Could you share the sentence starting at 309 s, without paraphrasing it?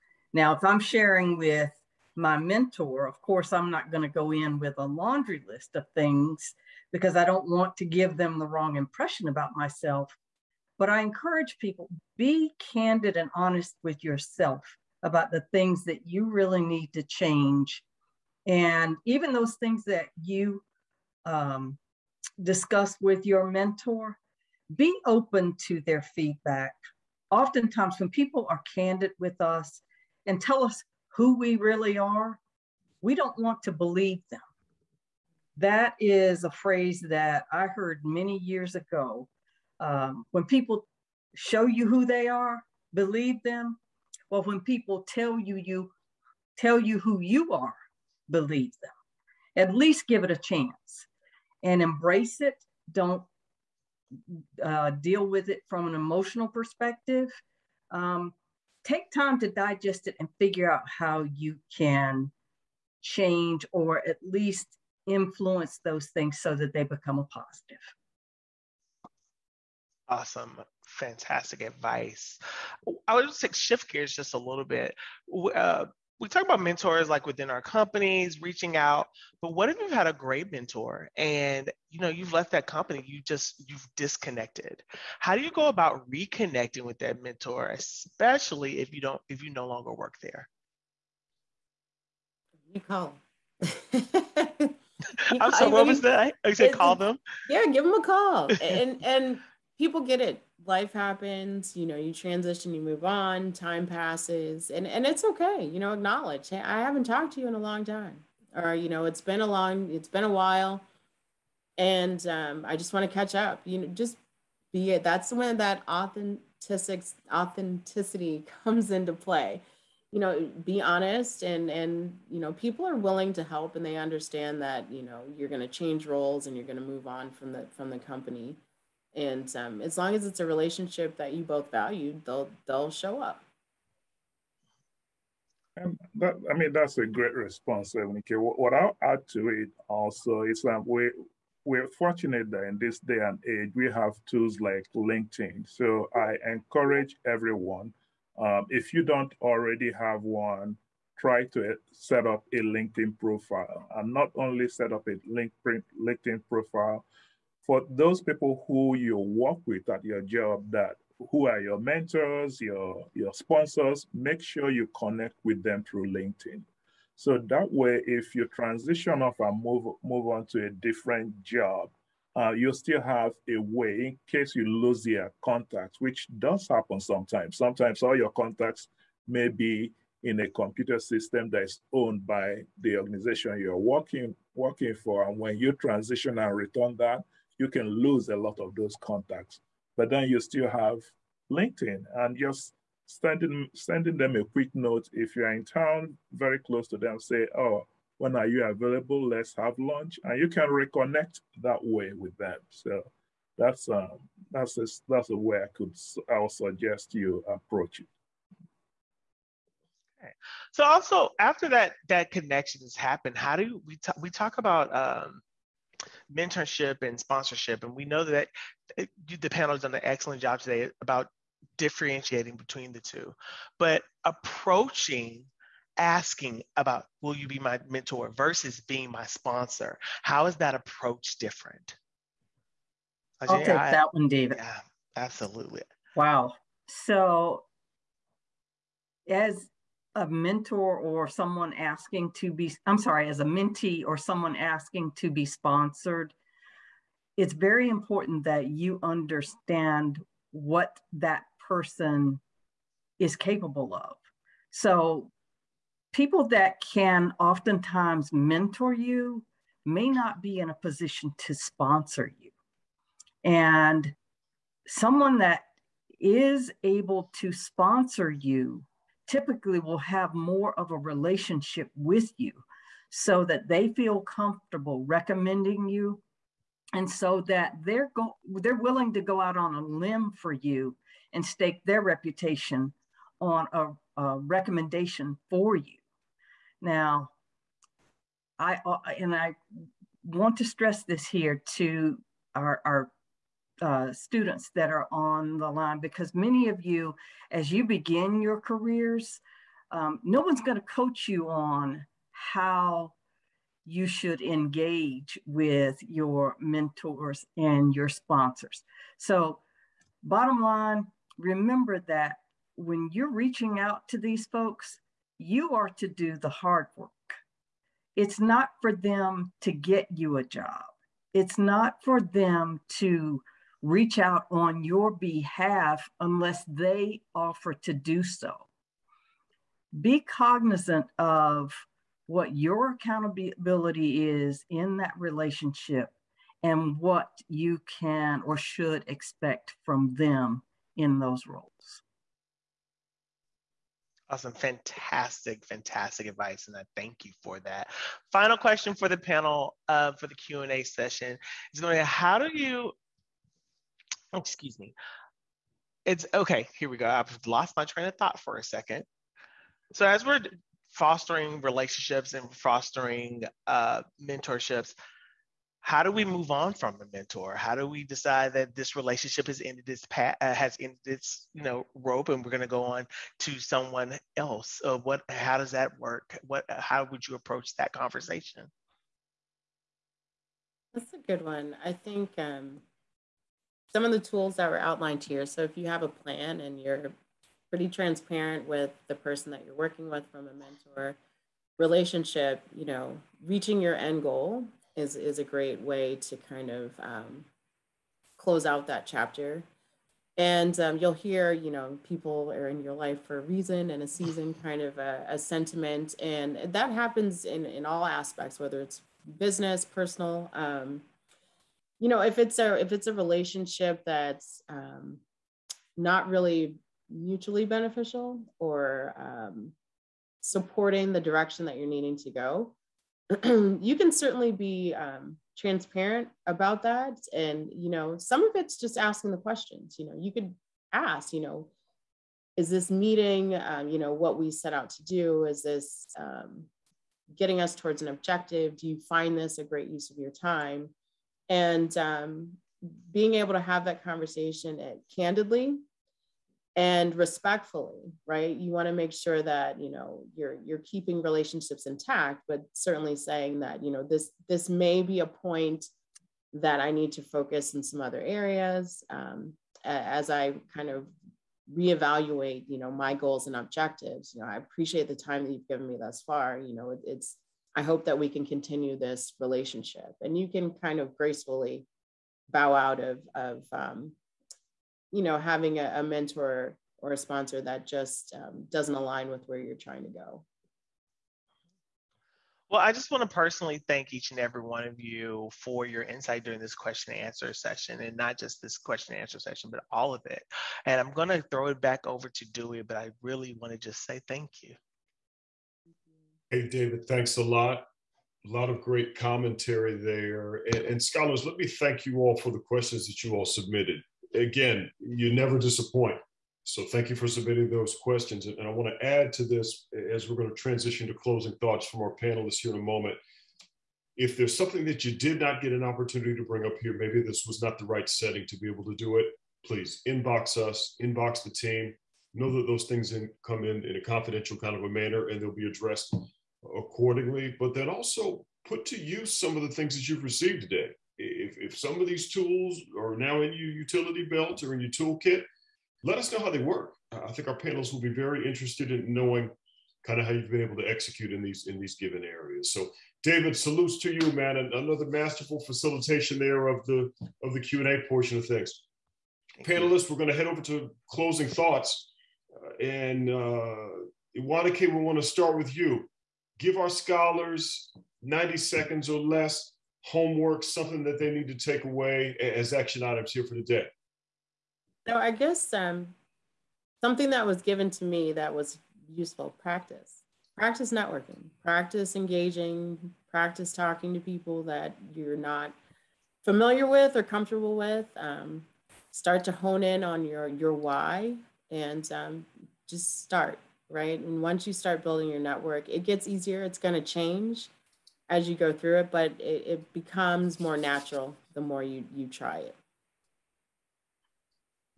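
So, bottom line, remember that when you're reaching out to these folks, you are to do the hard work.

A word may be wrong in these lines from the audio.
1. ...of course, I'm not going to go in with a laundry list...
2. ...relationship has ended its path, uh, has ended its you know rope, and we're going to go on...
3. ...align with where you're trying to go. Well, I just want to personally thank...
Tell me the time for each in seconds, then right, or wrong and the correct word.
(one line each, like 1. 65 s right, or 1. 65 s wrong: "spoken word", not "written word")
1. 3 s right
2. 368 s right
3. 478 s right.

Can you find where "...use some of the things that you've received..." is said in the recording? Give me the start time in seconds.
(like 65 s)
528 s.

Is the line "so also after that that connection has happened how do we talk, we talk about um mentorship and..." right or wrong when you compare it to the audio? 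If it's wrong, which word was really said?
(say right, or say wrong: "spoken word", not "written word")
right.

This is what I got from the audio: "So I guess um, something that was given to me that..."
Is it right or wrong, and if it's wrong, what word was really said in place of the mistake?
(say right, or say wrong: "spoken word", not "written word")
right.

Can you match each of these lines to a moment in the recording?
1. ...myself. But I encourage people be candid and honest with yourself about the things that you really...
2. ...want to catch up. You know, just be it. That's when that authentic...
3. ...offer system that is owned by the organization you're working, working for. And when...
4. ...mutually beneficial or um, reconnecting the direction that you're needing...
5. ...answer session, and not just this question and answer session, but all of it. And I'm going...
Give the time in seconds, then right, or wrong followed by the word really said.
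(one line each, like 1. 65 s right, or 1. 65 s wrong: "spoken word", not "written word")
1. 9 s right
2. 112 s right
3. 180 s wrong: "computer", not "offer"
4. 417 s wrong: "supporting", not "reconnecting"
5. 487 s right.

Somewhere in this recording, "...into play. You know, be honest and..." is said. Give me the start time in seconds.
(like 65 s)
118 s.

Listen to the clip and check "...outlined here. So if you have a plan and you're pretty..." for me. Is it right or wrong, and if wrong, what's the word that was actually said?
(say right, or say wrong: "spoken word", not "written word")
right.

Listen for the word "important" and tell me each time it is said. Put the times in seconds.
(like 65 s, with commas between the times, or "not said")
247 s.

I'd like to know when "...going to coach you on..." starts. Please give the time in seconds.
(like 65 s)
300 s.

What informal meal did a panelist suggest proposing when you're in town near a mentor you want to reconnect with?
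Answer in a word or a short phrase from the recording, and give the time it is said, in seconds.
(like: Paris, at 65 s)
Lunch, at 199 s.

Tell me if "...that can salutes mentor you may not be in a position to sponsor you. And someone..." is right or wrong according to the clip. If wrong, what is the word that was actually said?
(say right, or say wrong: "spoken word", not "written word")
wrong: "oftentimes", not "salutes".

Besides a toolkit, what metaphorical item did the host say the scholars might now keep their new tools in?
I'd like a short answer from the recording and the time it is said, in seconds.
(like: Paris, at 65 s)
Utility belt, at 533 s.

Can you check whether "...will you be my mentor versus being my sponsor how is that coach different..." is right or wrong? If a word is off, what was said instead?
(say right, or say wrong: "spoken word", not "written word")
wrong: "approach", not "coach".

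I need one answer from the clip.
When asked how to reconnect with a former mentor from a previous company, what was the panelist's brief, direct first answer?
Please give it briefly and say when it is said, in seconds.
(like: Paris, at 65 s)
Call them, at 96 s.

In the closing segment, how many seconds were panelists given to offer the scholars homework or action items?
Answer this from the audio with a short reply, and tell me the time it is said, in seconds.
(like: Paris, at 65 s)
90, at 558 s.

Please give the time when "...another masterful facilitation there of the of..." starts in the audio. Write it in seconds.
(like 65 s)
544 s.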